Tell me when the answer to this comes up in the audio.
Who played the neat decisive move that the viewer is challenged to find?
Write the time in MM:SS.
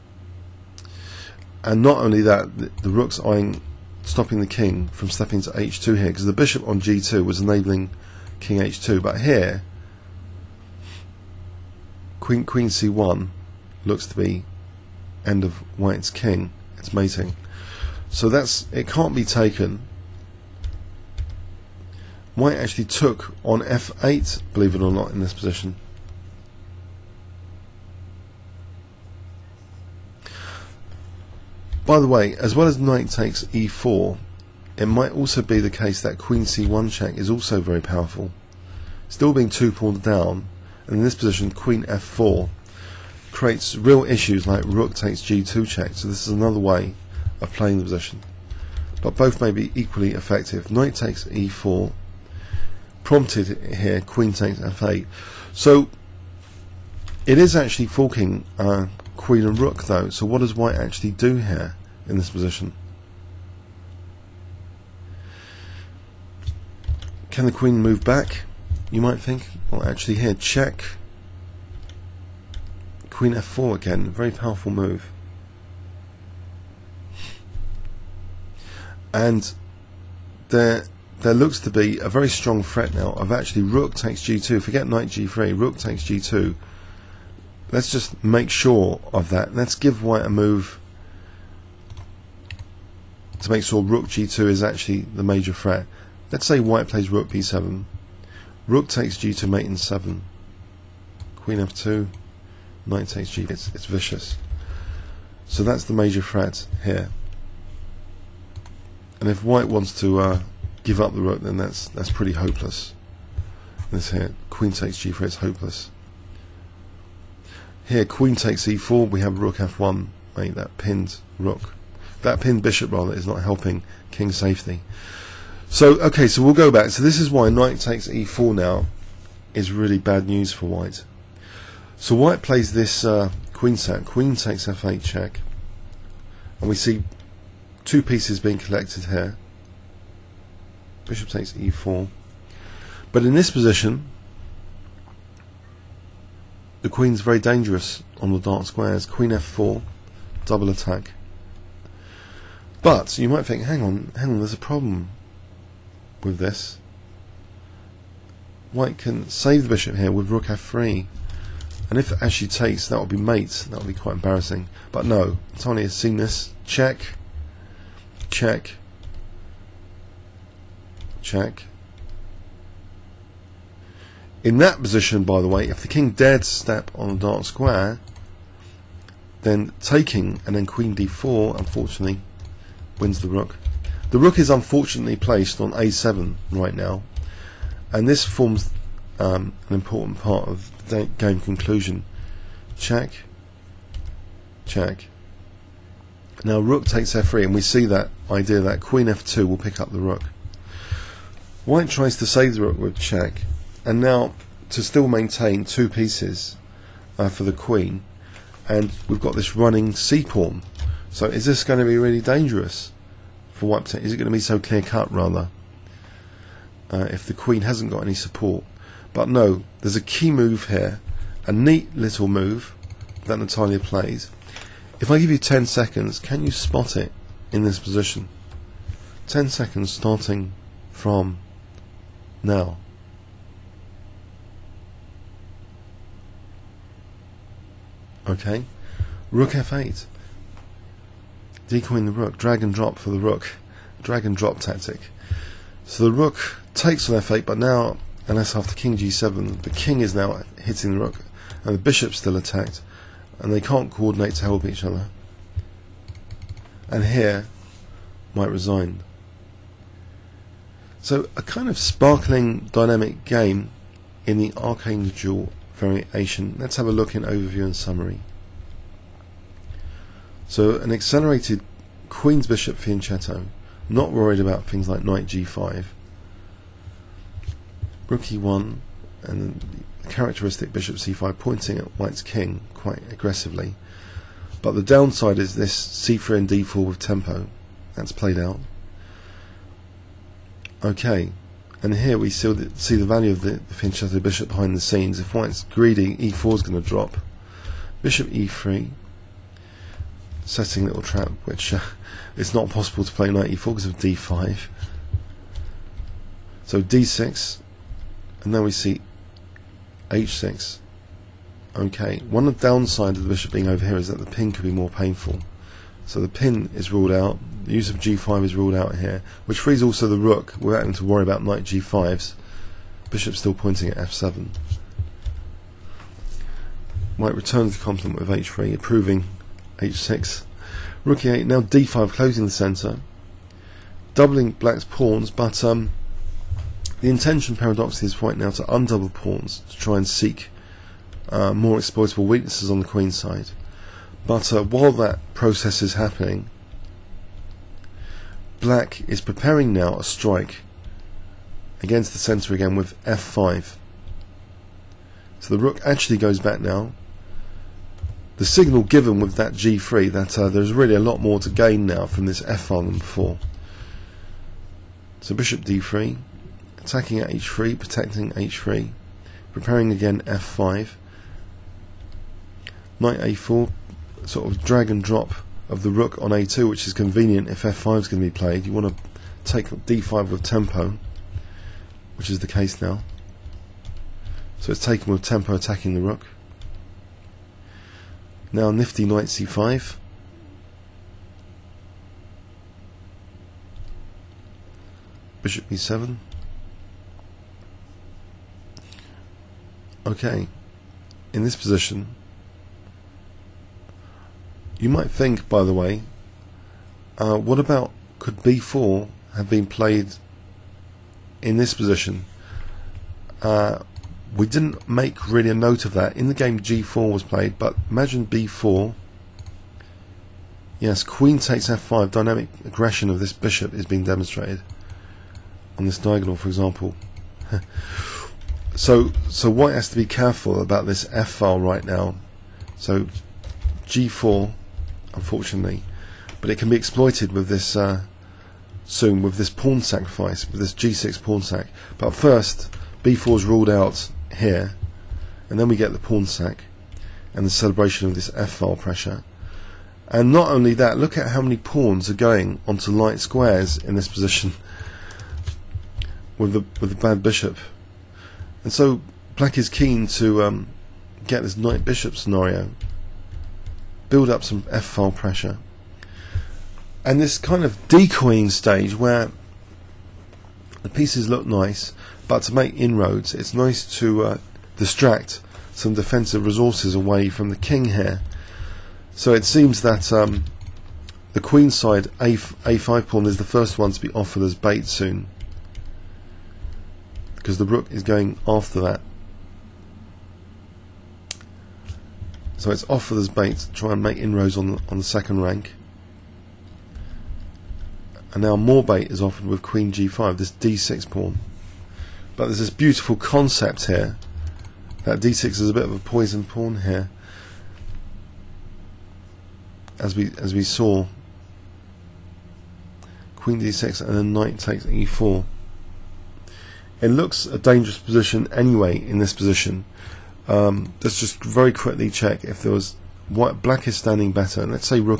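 03:43.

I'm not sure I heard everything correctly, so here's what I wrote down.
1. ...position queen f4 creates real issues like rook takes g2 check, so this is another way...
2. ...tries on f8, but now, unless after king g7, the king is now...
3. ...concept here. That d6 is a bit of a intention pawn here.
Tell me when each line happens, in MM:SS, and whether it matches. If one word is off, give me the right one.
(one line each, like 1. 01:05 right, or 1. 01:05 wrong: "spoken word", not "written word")
1. 00:41 right
2. 04:06 wrong: "takes", not "tries"
3. 08:23 wrong: "poison", not "intention".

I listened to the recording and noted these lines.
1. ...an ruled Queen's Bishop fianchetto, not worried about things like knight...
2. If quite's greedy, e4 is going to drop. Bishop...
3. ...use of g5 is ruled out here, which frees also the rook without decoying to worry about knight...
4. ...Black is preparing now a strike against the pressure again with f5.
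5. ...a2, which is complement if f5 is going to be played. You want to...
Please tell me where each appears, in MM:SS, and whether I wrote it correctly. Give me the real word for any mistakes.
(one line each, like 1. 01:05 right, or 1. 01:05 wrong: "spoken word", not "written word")
1. 04:30 wrong: "accelerated", not "ruled"
2. 04:55 wrong: "white", not "quite"
3. 05:17 wrong: "having", not "decoying"
4. 05:48 wrong: "centre", not "pressure"
5. 06:16 wrong: "convenient", not "complement".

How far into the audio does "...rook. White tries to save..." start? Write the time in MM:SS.
03:19.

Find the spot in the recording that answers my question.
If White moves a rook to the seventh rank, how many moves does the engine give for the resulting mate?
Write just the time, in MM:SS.
01:39.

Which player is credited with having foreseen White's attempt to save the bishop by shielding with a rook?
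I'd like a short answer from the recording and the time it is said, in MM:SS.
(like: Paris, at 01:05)
Tony, at 02:45.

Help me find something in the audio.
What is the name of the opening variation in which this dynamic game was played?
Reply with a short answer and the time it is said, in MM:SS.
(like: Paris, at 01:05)
Archangel variation, at 04:24.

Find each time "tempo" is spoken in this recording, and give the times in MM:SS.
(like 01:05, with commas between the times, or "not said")
04:46, 06:20, 06:25.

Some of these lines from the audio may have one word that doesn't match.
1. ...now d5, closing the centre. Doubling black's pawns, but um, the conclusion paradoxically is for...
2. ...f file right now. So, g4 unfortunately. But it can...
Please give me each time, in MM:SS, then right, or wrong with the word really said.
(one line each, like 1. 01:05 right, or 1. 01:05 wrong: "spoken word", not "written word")
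1. 05:31 wrong: "intention", not "conclusion"
2. 07:11 right.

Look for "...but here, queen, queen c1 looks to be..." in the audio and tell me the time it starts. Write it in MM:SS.
00:09.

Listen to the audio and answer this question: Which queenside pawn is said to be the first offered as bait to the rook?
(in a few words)
a5 pawn.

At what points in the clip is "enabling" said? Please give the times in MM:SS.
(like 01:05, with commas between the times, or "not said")
00:07.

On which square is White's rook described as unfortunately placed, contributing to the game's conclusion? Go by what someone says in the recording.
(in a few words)
a7.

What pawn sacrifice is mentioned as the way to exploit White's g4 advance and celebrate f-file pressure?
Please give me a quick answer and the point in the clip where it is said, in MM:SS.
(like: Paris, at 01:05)
g6 pawn sac, at 07:20.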